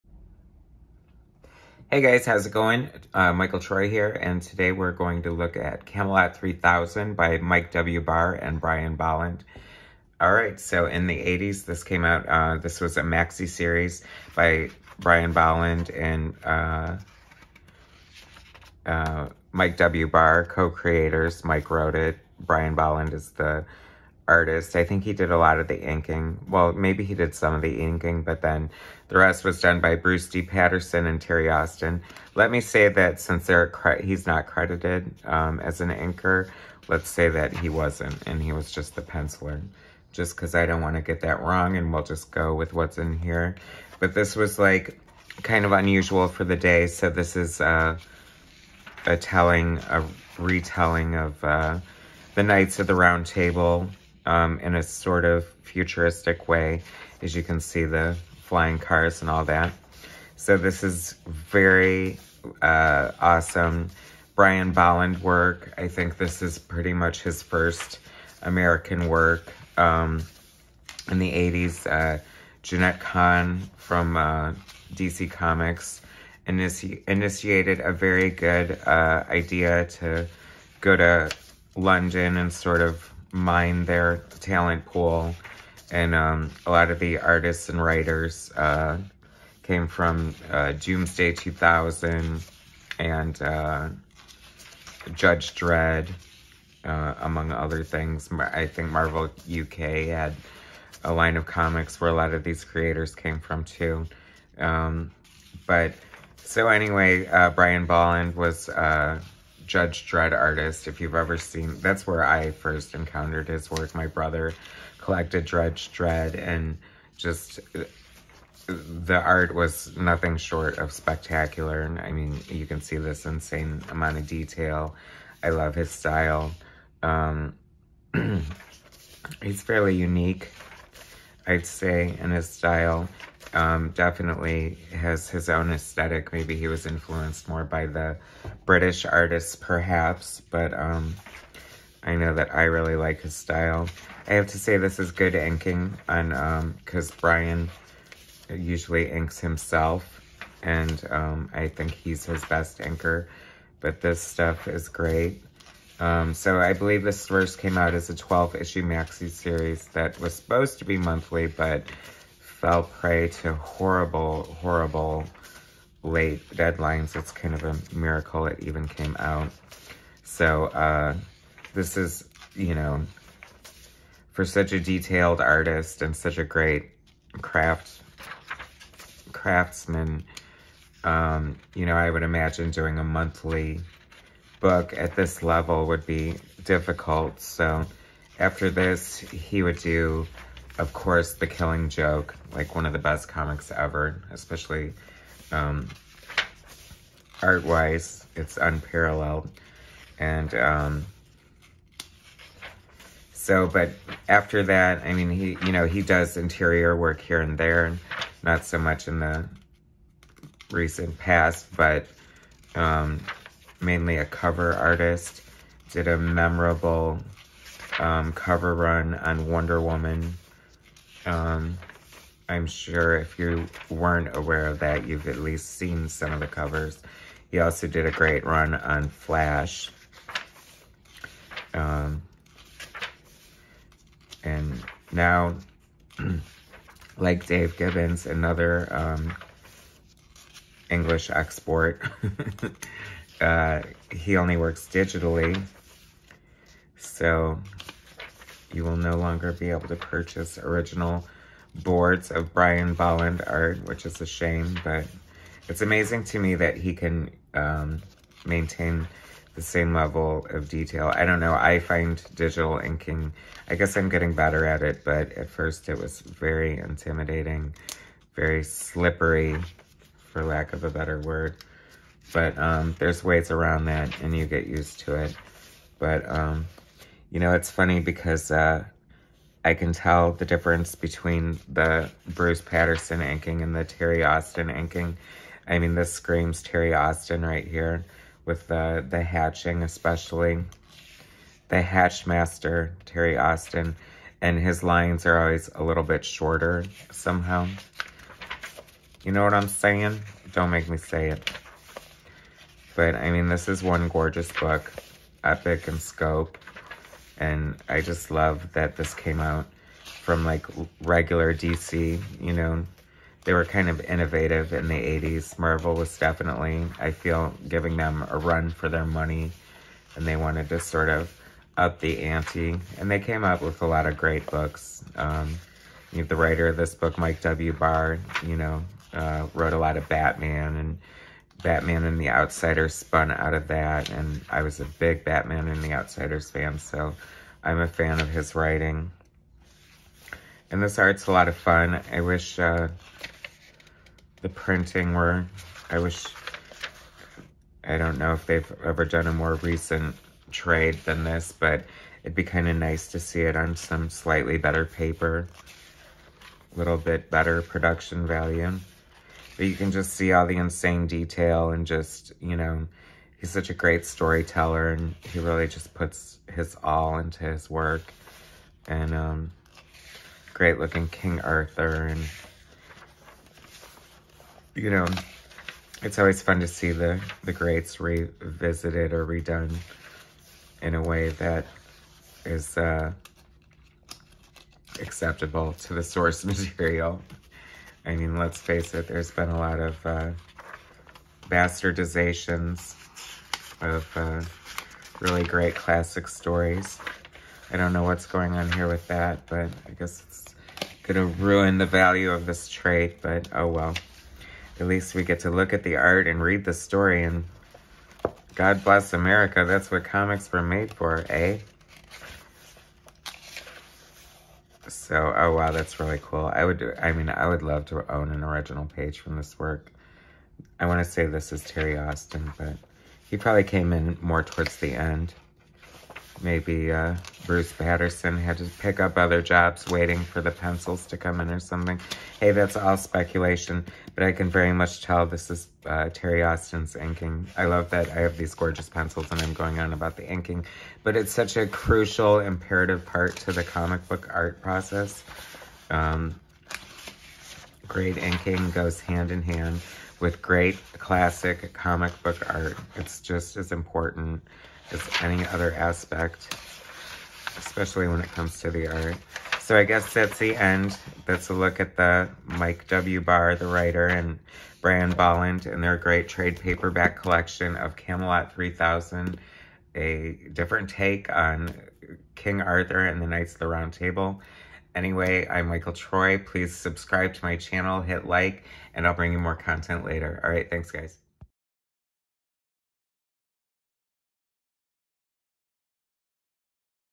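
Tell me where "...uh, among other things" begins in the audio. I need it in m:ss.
1:36.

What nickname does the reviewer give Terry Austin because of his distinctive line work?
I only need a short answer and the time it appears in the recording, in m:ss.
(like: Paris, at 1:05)
The hatch master, at 4:51.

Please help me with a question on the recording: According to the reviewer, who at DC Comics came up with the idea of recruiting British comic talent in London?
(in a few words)
Jenette Kahn.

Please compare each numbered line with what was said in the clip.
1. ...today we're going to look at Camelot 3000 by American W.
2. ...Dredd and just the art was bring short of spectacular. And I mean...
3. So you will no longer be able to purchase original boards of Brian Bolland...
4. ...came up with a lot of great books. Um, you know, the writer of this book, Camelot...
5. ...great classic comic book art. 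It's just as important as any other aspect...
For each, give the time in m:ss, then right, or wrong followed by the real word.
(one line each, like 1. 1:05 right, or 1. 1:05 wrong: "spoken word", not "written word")
1. 0:04 wrong: "Mike", not "American"
2. 1:55 wrong: "nothing", not "bring"
3. 4:06 right
4. 5:23 wrong: "Mike", not "Camelot"
5. 7:30 right.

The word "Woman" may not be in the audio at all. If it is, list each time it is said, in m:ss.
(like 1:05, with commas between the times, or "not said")
3:39.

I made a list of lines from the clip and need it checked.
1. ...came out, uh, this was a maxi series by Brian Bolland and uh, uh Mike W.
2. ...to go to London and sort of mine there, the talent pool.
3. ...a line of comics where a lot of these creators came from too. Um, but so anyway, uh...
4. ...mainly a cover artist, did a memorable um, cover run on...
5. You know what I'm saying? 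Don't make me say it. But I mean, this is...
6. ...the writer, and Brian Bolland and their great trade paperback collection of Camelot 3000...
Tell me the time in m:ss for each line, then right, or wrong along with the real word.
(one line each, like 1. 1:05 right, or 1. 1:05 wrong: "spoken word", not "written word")
1. 0:11 right
2. 1:19 right
3. 1:41 right
4. 3:33 right
5. 4:59 right
6. 7:43 right.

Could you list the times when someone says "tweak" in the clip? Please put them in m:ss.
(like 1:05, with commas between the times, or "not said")
not said.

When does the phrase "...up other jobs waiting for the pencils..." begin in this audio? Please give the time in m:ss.
7:09.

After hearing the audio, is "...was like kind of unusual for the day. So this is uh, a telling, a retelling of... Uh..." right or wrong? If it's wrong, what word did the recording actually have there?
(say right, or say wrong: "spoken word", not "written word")
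right.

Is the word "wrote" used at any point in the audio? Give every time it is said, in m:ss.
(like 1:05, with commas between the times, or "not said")
0:21, 5:29.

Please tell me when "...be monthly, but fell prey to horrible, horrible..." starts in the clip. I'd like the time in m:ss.
2:40.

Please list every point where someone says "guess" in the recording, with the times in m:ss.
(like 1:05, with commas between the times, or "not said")
4:23, 6:39, 7:39.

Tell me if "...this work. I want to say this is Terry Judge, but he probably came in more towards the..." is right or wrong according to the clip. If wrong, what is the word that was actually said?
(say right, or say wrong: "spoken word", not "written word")
wrong: "Austin", not "Judge".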